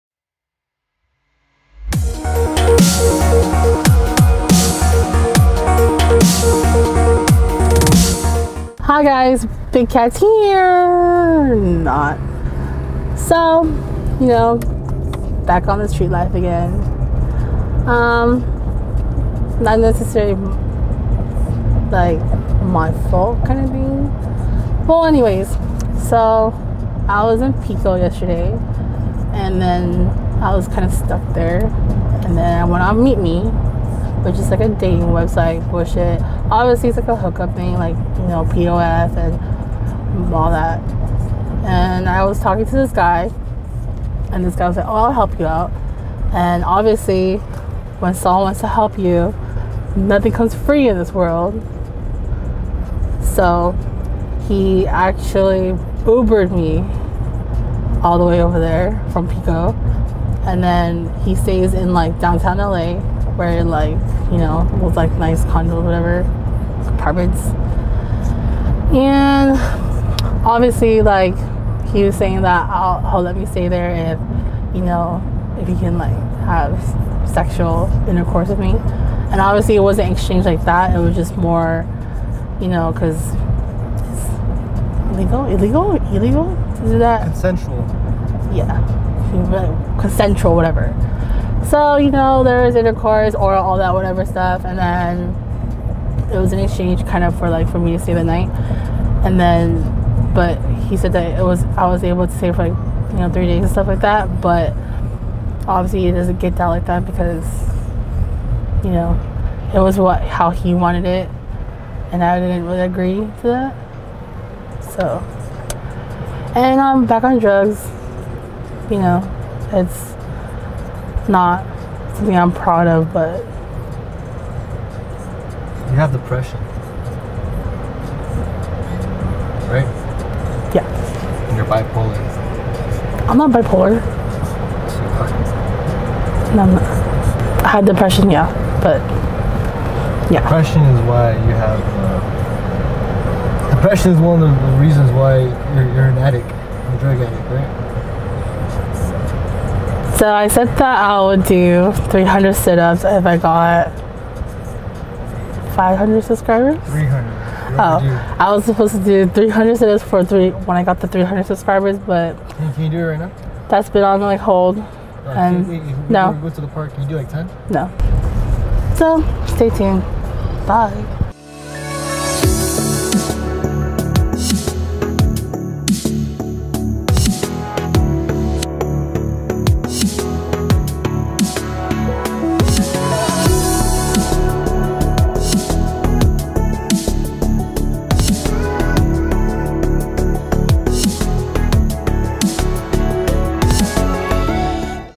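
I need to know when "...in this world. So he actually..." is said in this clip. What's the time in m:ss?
0:50.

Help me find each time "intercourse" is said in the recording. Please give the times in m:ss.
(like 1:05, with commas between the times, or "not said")
1:18, 1:32.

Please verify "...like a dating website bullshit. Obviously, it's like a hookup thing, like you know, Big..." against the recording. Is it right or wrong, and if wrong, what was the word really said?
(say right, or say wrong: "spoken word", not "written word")
wrong: "POF", not "Big".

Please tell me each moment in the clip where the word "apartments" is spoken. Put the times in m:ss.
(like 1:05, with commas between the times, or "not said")
1:06.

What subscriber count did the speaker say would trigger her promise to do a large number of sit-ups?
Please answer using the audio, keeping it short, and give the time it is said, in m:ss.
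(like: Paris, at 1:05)
500, at 2:35.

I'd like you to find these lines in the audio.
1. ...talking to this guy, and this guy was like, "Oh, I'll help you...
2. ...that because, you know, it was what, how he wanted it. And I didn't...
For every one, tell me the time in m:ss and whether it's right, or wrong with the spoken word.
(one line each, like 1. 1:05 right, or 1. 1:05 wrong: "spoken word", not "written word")
1. 0:42 right
2. 1:46 right.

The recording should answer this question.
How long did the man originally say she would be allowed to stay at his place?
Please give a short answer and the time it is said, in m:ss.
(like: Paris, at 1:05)
3 days, at 1:43.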